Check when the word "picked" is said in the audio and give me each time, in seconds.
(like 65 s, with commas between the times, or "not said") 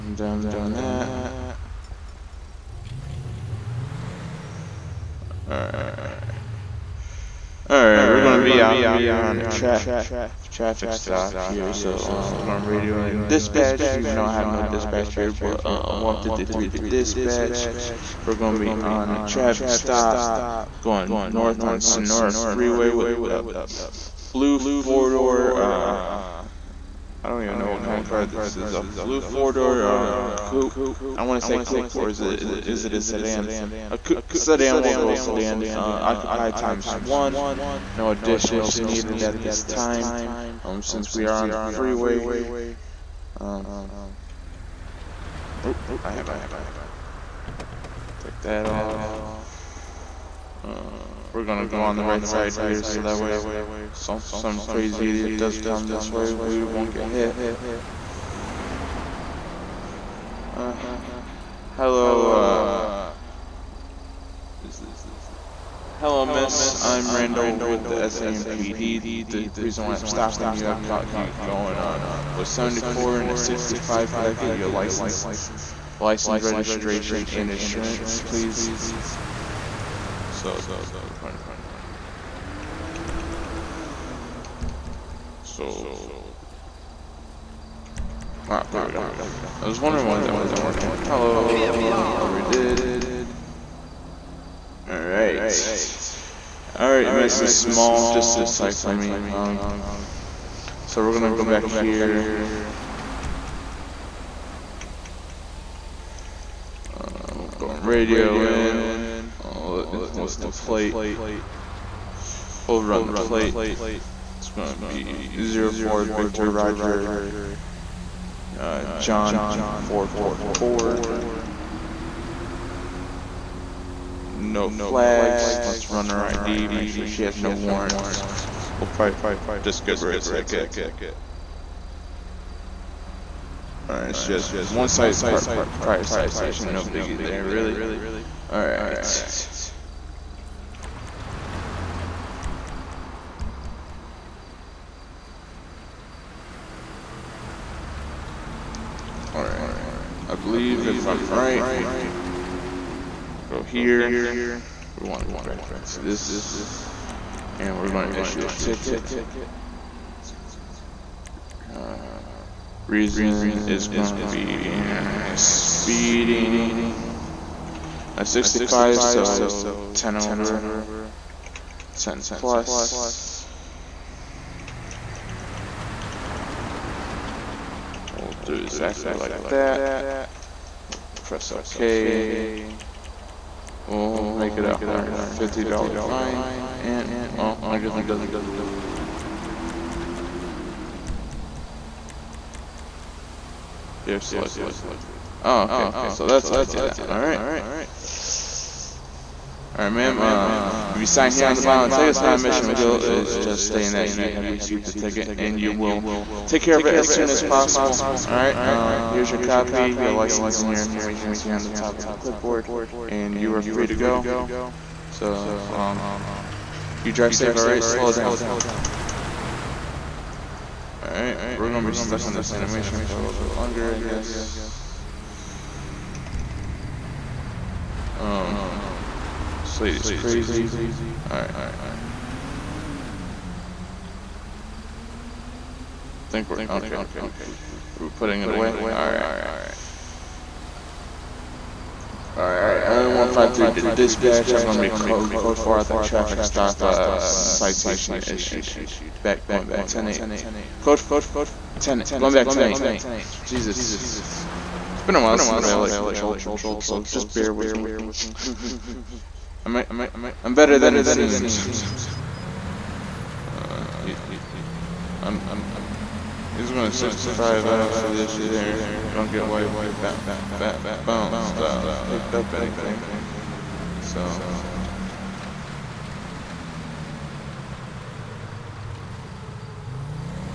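272 s.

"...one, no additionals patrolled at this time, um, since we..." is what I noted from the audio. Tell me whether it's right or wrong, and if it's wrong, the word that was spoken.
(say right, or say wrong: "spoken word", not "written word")
wrong: "needed", not "patrolled".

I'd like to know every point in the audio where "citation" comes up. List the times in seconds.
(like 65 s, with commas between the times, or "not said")
136 s, 247 s.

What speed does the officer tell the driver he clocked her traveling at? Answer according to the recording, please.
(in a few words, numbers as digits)
74.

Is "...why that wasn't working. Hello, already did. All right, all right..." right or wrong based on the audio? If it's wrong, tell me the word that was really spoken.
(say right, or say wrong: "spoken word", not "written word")
right.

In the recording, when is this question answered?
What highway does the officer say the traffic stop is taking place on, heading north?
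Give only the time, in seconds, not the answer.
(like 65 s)
21 s.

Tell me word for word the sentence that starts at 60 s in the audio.
Uh, hello, uh, it, hello miss, I'm Randall with the SAMPD.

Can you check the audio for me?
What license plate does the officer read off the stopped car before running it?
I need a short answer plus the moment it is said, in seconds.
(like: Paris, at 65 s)
04 Victor Roger John 444, at 115 s.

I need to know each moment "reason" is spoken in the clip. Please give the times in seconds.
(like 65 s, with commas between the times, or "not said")
69 s, 162 s.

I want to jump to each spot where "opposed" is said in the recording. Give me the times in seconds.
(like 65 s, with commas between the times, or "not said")
not said.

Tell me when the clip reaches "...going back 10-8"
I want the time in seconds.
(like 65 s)
252 s.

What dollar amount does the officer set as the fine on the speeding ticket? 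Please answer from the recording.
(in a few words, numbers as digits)
$150.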